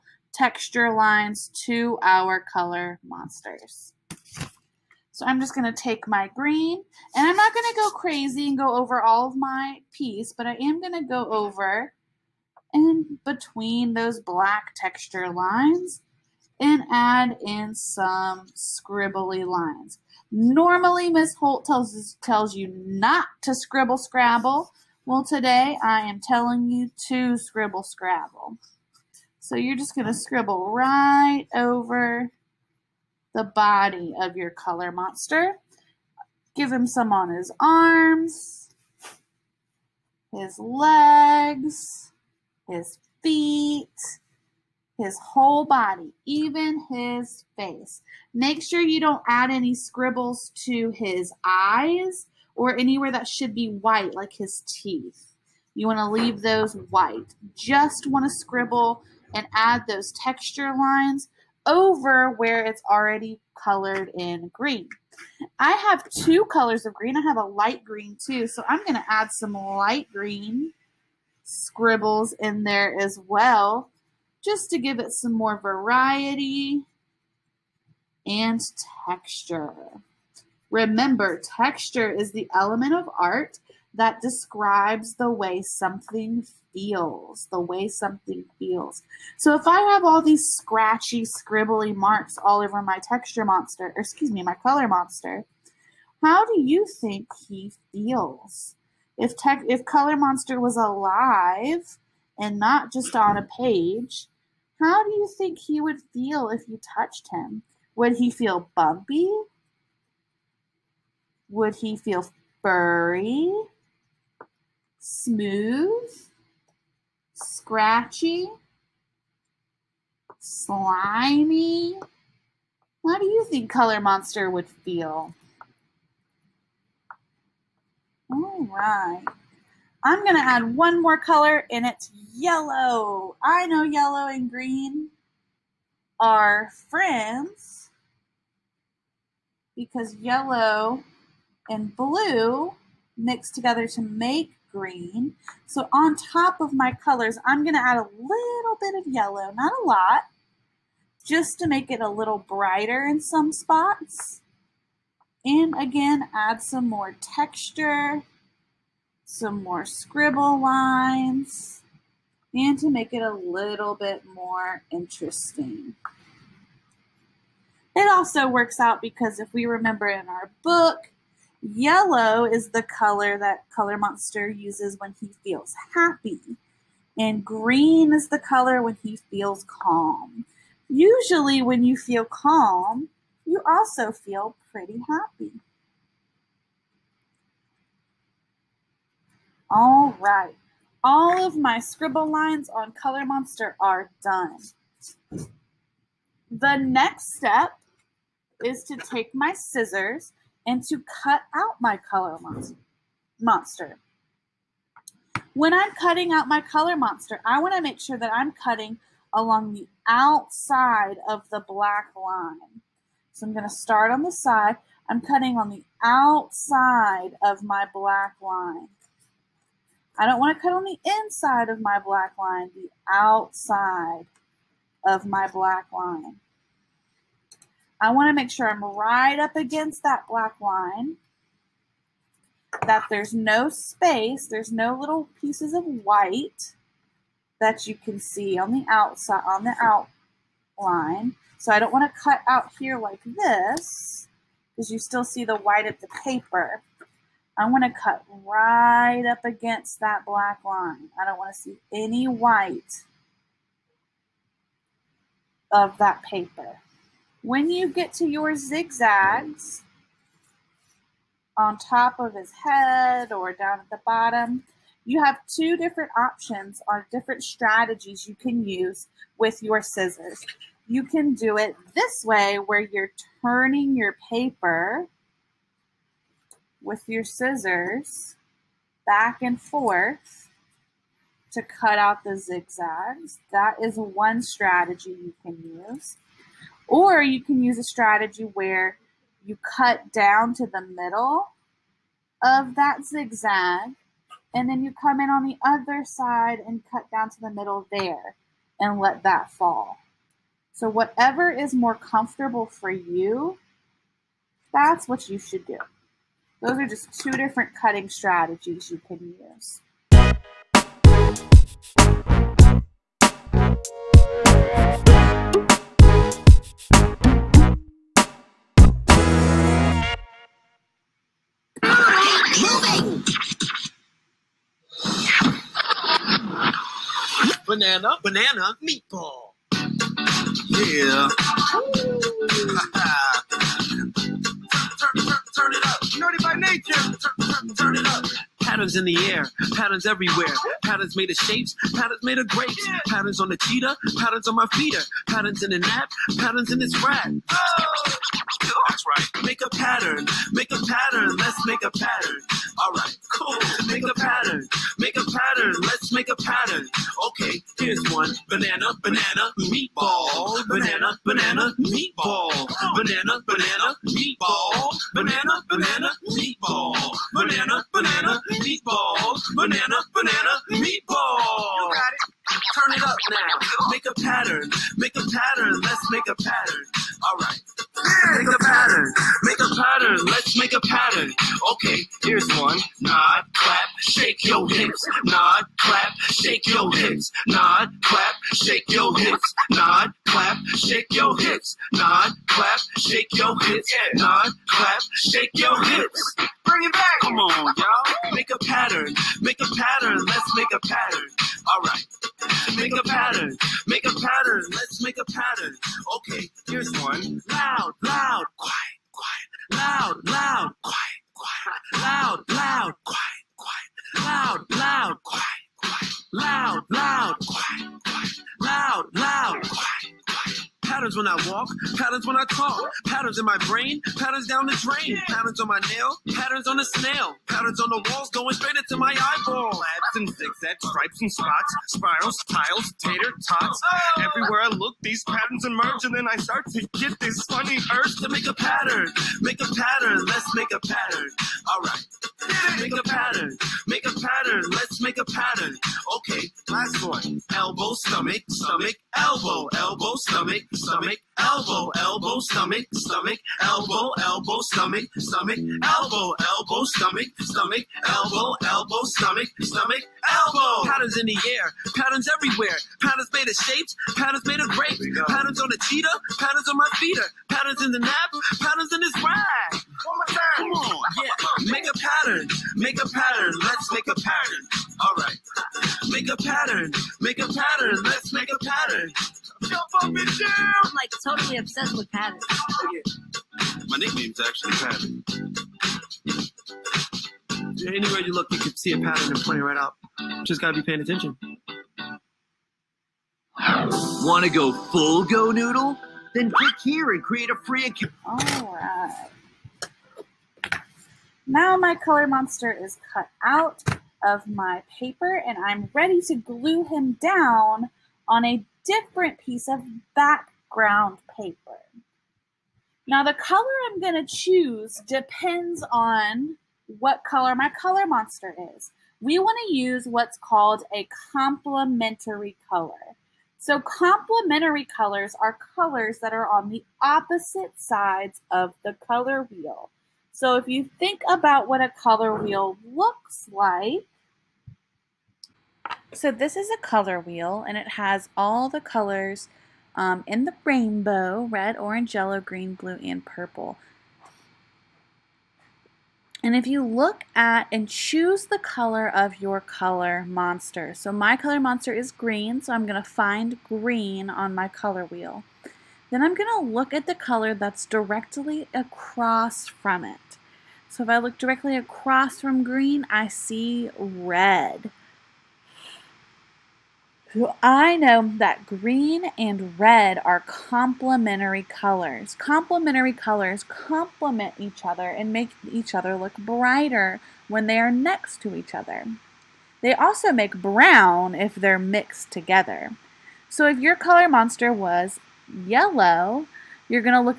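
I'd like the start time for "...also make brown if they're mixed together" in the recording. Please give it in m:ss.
9:39.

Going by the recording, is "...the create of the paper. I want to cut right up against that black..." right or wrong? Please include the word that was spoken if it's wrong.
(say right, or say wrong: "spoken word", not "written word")
wrong: "white", not "create".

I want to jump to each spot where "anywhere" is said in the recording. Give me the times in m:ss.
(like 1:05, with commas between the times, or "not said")
0:52, 8:07.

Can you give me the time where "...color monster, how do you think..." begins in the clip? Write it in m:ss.
1:34.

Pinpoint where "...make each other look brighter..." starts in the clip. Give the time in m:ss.
9:35.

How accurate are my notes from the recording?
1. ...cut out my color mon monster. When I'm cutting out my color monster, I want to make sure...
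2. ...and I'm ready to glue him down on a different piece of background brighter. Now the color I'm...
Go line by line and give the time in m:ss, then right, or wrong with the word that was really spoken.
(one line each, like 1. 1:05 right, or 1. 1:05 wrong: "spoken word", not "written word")
1. 3:21 right
2. 8:25 wrong: "paper", not "brighter".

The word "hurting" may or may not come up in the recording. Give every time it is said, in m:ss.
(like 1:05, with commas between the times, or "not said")
not said.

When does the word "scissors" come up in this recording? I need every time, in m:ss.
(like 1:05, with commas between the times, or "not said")
3:19, 4:29, 4:37.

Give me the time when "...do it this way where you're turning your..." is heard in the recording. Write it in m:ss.
4:31.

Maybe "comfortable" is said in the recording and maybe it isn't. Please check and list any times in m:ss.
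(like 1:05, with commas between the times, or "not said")
5:01.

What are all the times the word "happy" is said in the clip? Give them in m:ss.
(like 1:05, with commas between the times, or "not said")
2:55, 3:05.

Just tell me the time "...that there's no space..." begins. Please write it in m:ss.
3:52.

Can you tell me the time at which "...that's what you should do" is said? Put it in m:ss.
5:04.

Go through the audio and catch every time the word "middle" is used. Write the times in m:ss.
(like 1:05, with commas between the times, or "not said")
4:50, 4:57.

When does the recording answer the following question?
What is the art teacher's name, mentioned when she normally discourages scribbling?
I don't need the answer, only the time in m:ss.
0:21.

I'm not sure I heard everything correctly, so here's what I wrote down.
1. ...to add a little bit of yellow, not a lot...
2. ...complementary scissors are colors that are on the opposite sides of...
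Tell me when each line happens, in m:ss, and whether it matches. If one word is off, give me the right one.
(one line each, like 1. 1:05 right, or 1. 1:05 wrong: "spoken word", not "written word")
1. 2:27 right
2. 8:43 wrong: "colors", not "scissors".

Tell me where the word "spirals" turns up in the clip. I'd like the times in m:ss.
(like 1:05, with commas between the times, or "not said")
7:11.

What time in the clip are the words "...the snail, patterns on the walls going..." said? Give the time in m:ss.
7:06.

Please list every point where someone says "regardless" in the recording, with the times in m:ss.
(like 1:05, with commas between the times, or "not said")
not said.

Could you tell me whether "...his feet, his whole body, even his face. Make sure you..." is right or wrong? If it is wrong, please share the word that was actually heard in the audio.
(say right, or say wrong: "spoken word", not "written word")
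right.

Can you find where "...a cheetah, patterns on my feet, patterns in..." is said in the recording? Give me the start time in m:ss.
7:45.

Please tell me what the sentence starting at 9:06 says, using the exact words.
And if you look at and choose the color of your color monster.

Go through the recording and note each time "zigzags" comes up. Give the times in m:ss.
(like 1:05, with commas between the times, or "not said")
4:18, 4:42, 4:53, 7:10.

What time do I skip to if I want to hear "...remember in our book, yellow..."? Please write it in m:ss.
2:49.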